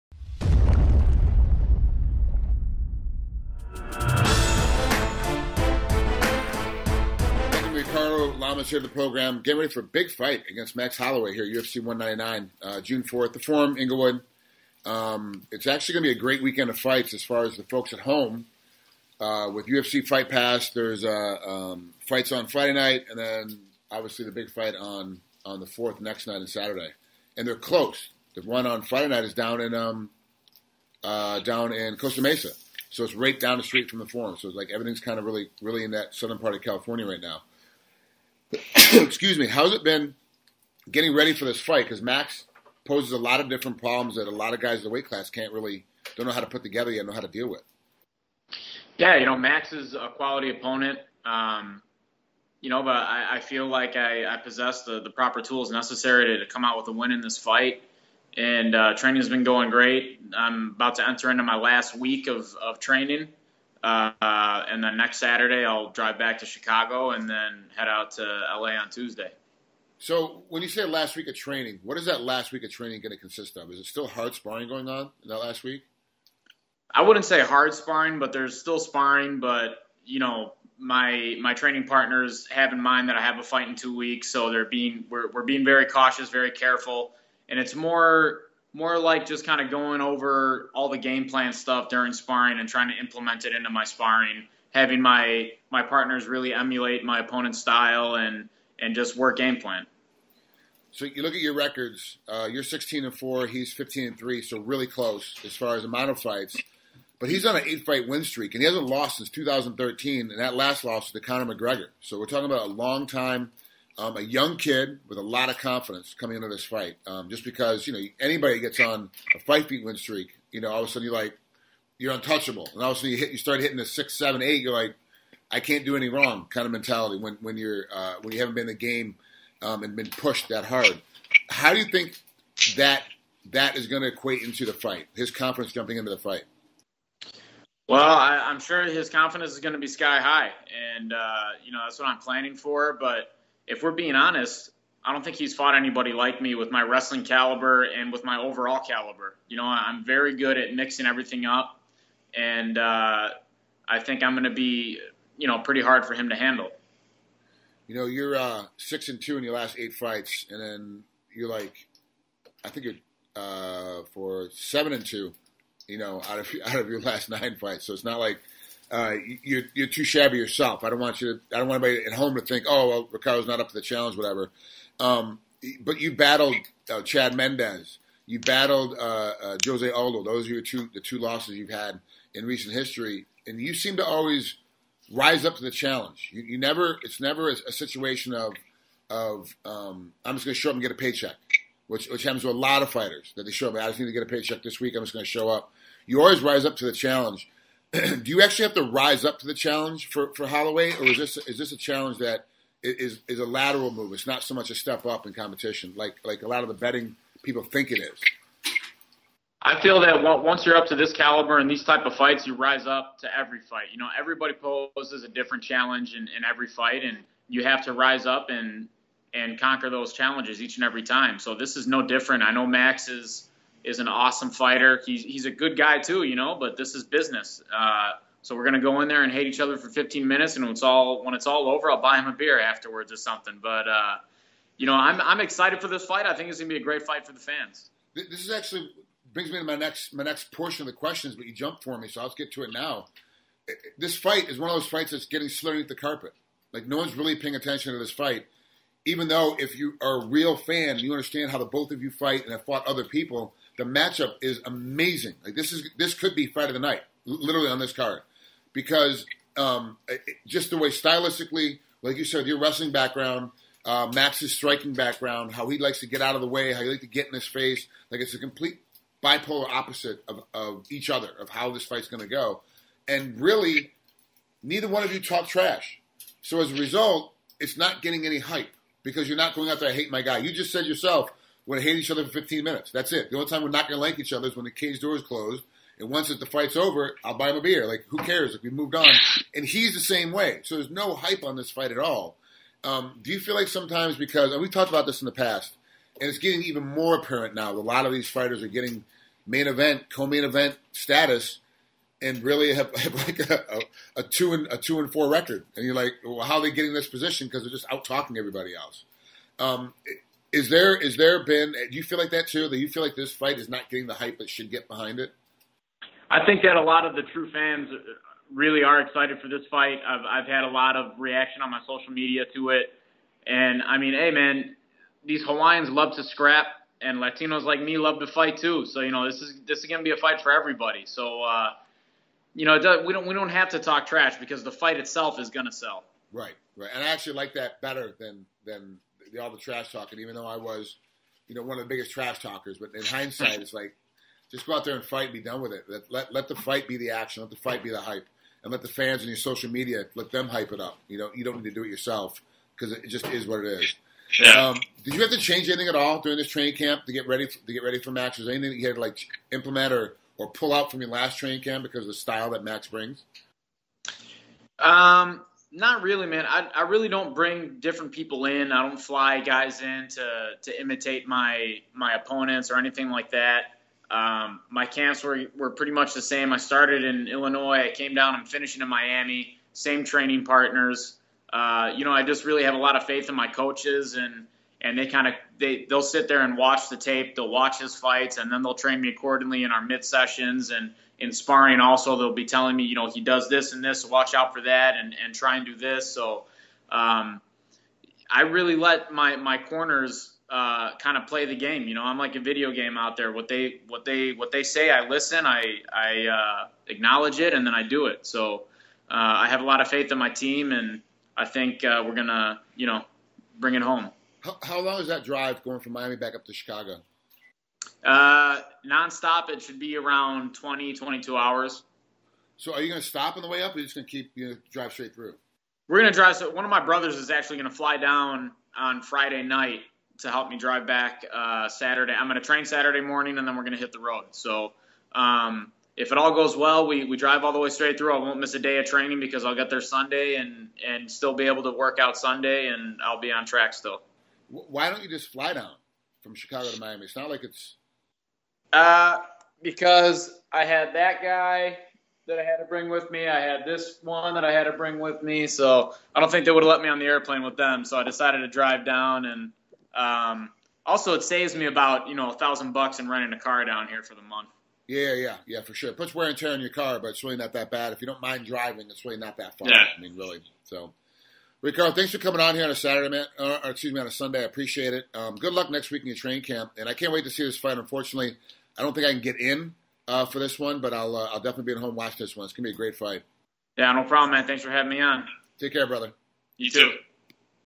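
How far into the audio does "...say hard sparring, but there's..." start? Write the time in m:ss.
1:17.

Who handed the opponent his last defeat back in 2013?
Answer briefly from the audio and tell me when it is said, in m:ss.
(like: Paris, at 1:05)
Conor McGregor, at 1:51.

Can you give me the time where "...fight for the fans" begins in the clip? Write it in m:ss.
3:57.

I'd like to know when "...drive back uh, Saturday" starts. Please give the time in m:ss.
7:10.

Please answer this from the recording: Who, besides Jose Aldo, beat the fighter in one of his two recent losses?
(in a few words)
Chad Mendes.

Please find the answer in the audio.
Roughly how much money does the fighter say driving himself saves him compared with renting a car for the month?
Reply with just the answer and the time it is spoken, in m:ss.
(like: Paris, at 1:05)
$1,000, at 7:42.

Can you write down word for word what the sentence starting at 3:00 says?
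Those are your two, the two losses you've had in recent history.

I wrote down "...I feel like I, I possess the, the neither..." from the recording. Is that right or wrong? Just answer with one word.
wrong.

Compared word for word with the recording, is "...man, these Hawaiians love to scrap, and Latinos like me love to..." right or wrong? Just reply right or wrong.
right.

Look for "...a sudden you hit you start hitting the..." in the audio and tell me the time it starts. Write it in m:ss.
2:02.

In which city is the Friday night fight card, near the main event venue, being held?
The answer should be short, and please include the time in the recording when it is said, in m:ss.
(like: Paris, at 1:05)
Costa Mesa, at 0:31.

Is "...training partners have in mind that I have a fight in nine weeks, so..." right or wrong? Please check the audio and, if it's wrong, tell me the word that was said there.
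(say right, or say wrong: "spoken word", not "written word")
wrong: "two", not "nine".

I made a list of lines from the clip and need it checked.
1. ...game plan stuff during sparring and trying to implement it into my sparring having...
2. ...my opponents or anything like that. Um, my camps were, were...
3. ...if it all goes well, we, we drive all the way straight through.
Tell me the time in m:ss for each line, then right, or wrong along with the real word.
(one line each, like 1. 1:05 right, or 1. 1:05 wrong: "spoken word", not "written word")
1. 1:30 right
2. 6:11 right
3. 7:15 right.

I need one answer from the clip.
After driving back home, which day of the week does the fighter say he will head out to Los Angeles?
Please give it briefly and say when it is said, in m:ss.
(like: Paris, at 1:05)
Tuesday, at 1:08.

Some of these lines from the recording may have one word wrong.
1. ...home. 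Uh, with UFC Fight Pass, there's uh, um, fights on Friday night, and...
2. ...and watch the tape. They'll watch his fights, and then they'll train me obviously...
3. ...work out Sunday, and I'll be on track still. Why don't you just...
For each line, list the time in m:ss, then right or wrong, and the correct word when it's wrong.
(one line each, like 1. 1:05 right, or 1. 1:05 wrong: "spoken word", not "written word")
1. 0:17 right
2. 6:26 wrong: "accordingly", not "obviously"
3. 7:21 right.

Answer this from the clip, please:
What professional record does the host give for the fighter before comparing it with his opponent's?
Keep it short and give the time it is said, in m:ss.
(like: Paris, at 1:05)
16 and 4, at 1:42.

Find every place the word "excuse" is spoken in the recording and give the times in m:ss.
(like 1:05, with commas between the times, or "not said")
0:38, 7:53.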